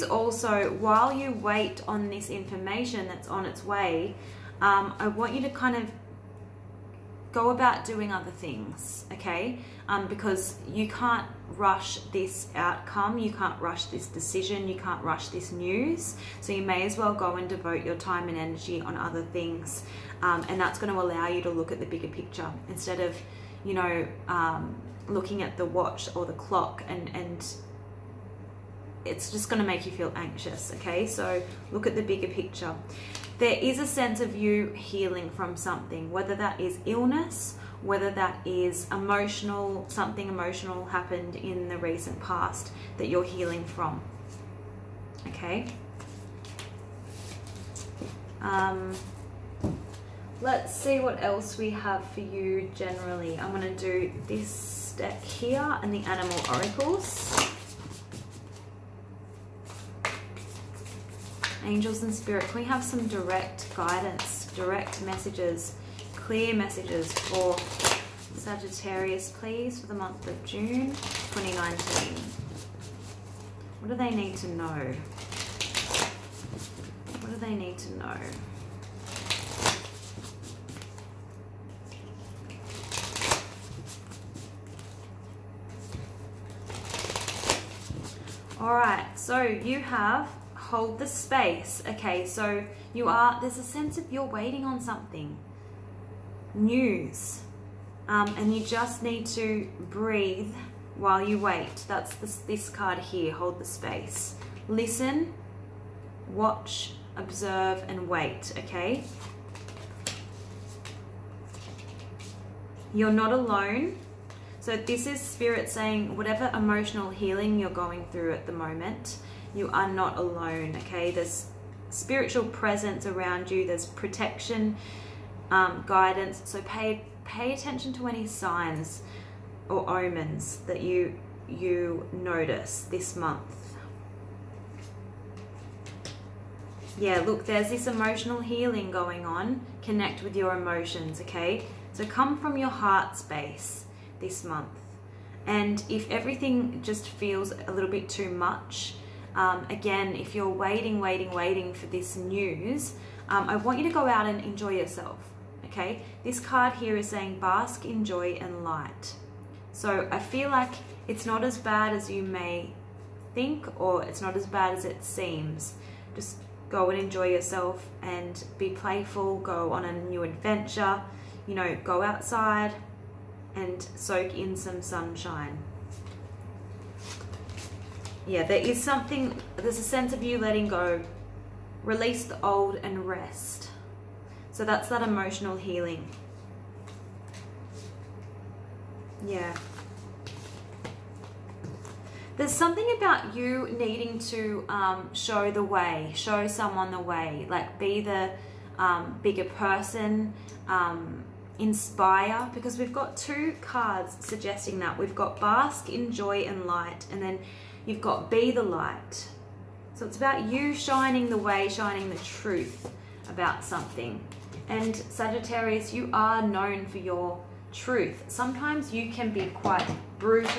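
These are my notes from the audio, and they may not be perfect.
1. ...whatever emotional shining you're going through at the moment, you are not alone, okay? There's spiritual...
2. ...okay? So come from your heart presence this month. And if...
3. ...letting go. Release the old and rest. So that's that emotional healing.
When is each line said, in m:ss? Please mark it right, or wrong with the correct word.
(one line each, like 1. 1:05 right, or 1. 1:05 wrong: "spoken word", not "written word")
1. 1:56 wrong: "healing", not "shining"
2. 2:21 wrong: "space", not "presence"
3. 3:00 right.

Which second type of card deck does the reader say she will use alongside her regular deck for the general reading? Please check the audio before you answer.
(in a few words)
animal oracles.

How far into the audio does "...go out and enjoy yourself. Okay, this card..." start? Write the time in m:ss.
2:33.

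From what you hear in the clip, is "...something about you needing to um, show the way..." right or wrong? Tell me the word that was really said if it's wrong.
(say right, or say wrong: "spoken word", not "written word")
right.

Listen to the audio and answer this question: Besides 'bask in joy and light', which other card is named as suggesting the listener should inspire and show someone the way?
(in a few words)
Be the light.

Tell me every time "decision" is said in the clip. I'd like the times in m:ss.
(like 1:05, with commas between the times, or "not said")
0:14.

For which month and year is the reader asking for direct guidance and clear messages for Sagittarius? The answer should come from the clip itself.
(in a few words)
June 2019.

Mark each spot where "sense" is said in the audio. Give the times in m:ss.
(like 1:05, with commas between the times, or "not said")
0:33, 1:33, 2:59.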